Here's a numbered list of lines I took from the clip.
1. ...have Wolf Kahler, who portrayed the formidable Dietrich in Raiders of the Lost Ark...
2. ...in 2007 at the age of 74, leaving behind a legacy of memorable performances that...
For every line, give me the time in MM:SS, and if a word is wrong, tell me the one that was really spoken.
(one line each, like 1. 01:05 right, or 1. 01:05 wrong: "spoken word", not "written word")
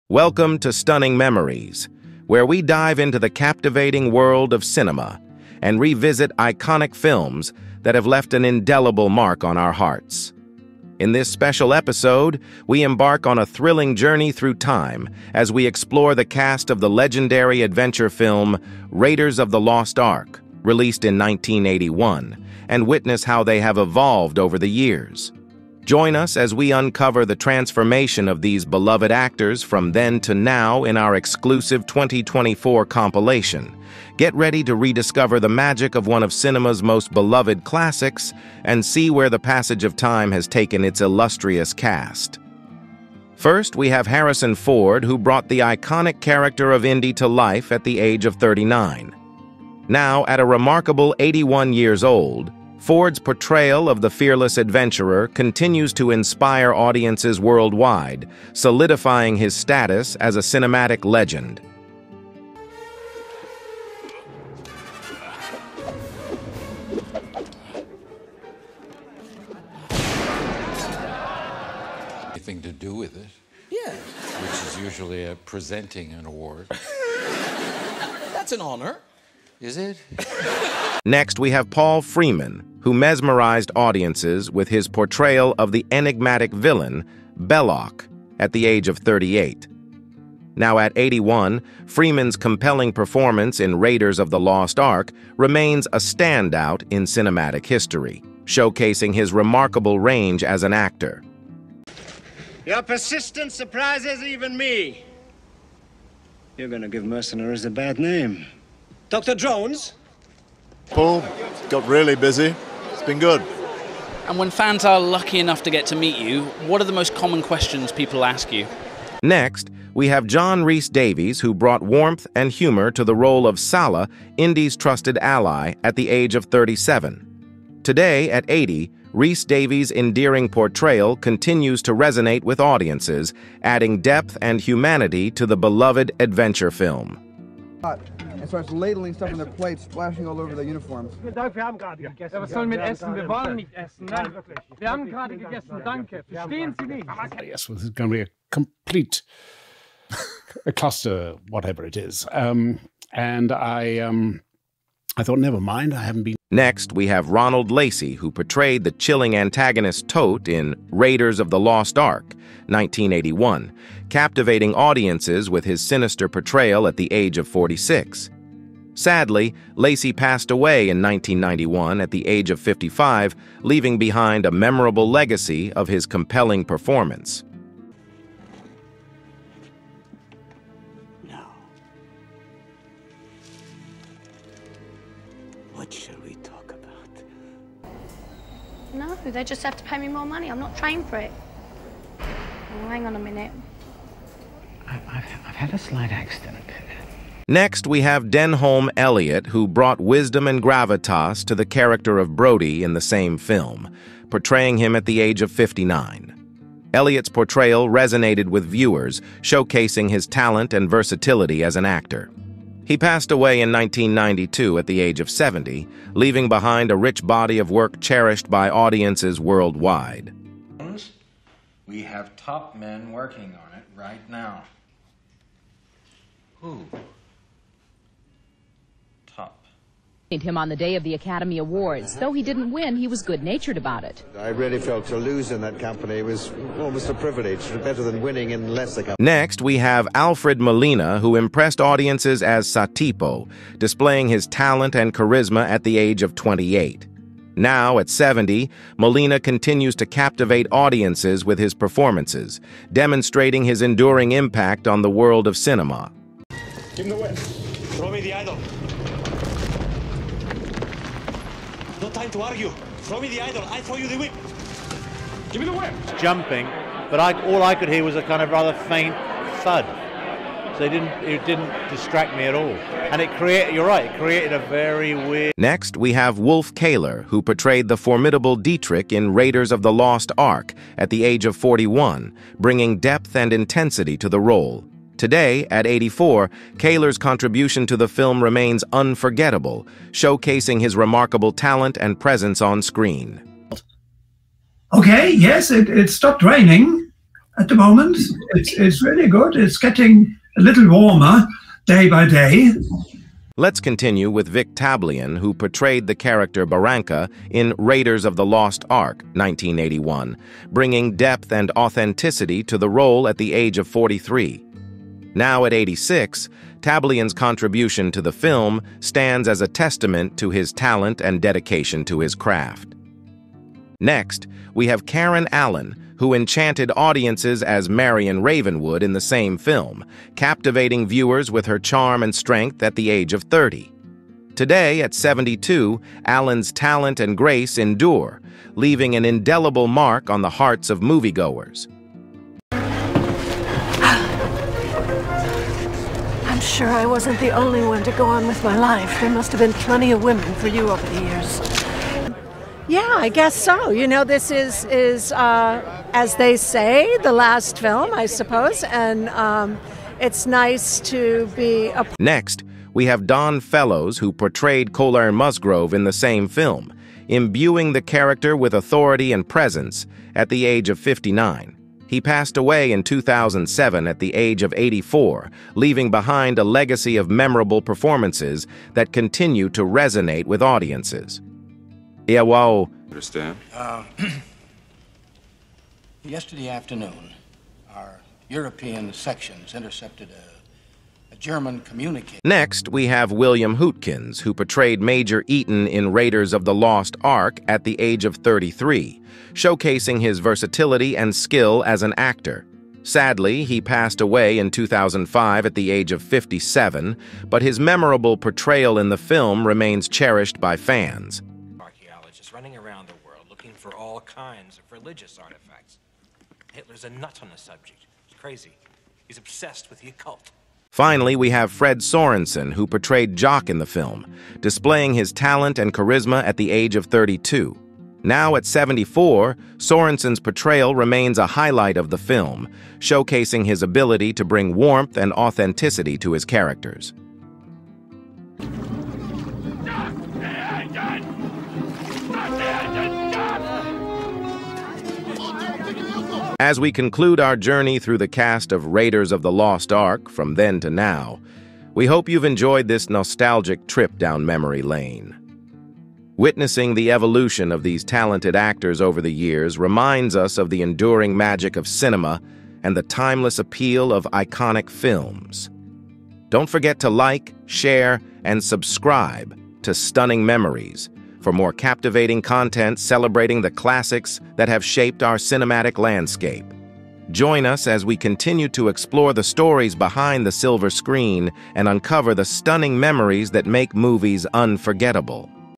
1. 04:36 right
2. 06:12 wrong: "84", not "74".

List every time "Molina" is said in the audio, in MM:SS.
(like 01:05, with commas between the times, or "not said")
04:00, 04:08.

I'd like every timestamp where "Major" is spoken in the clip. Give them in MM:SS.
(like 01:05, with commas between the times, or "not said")
06:35.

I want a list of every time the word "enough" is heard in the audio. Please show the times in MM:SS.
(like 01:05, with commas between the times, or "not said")
01:55.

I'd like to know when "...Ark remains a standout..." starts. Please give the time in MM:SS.
01:34.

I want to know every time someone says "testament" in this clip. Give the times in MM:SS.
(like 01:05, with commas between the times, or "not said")
05:19.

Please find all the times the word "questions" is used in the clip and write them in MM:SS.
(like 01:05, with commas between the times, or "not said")
01:57.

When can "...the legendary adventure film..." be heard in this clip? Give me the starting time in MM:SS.
00:16.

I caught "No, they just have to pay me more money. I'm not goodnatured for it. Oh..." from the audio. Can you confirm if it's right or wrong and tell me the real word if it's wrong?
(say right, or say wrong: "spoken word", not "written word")
wrong: "trained", not "goodnatured".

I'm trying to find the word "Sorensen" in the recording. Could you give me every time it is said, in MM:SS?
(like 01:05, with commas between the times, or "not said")
07:01, 07:09.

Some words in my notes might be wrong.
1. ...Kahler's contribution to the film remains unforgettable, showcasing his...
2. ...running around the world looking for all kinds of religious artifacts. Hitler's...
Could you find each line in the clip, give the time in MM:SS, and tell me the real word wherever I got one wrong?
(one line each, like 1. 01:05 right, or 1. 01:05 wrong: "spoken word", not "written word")
1. 04:46 right
2. 06:52 right.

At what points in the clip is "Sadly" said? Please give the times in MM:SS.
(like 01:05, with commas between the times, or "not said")
02:48, 06:43.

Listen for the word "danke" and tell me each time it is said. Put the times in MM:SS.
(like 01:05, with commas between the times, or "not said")
02:25.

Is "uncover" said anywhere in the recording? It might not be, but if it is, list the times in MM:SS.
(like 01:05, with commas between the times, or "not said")
00:26, 08:01.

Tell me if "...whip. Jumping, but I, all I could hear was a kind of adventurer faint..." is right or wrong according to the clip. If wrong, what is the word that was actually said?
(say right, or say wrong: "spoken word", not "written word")
wrong: "rather", not "adventurer".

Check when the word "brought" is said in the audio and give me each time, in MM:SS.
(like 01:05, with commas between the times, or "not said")
00:45, 02:01, 03:19.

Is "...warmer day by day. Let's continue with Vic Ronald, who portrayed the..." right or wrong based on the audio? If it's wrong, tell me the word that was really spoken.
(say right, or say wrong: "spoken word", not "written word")
wrong: "Tablian", not "Ronald".